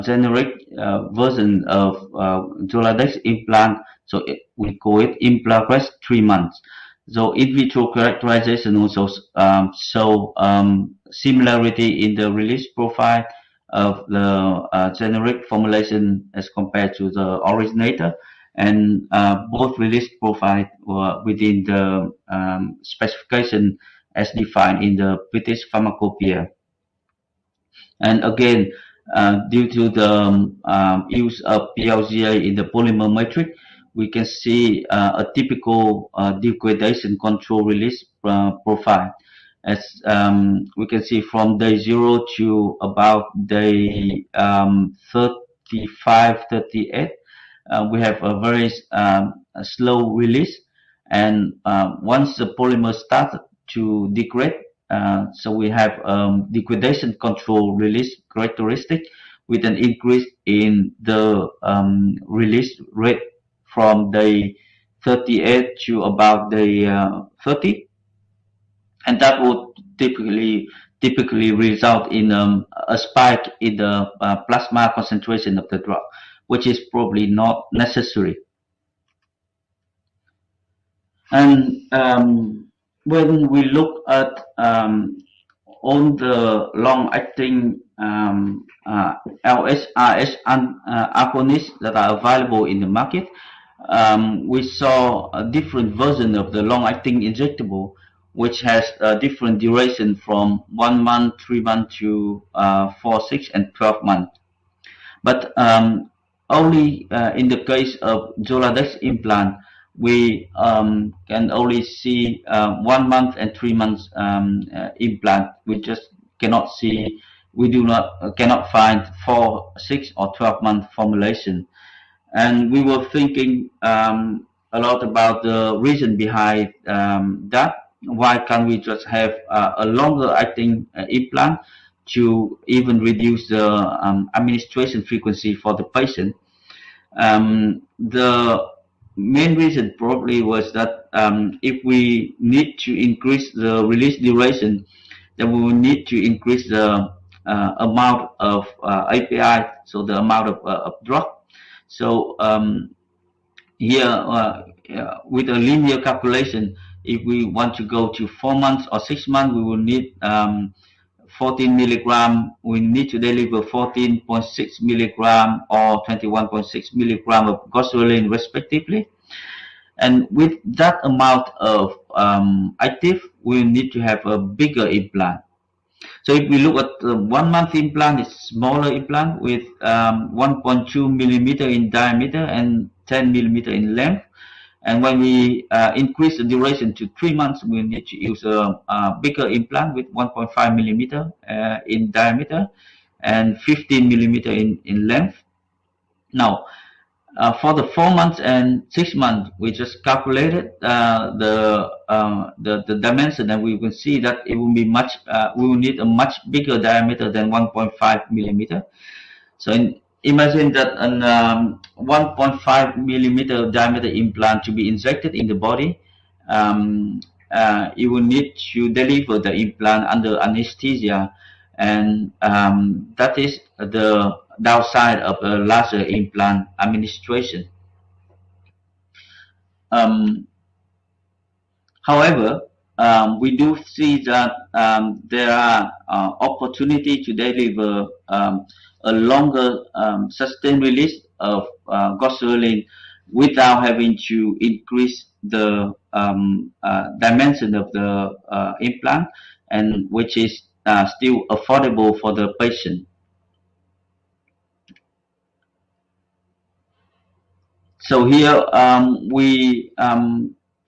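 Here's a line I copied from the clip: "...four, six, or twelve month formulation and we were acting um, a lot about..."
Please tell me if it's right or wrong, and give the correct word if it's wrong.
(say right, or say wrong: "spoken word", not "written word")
wrong: "thinking", not "acting".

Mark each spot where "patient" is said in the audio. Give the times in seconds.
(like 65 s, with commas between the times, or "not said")
135 s, 252 s.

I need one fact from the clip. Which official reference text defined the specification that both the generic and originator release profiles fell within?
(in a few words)
British Pharmacopoeia.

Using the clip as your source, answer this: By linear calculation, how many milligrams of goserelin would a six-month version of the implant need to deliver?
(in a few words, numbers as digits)
21.6 milligrams.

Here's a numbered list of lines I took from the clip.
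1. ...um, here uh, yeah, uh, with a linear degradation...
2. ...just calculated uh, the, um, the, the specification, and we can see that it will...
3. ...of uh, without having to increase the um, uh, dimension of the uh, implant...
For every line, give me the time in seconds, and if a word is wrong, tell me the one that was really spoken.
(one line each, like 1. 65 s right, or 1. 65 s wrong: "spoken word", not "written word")
1. 152 s wrong: "calculation", not "degradation"
2. 199 s wrong: "dimension", not "specification"
3. 241 s right.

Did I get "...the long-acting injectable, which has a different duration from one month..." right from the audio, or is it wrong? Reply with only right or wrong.
right.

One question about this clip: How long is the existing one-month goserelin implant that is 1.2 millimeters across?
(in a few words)
10 millimeters.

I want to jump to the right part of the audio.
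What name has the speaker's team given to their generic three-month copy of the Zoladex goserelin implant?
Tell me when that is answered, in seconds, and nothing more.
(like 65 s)
5 s.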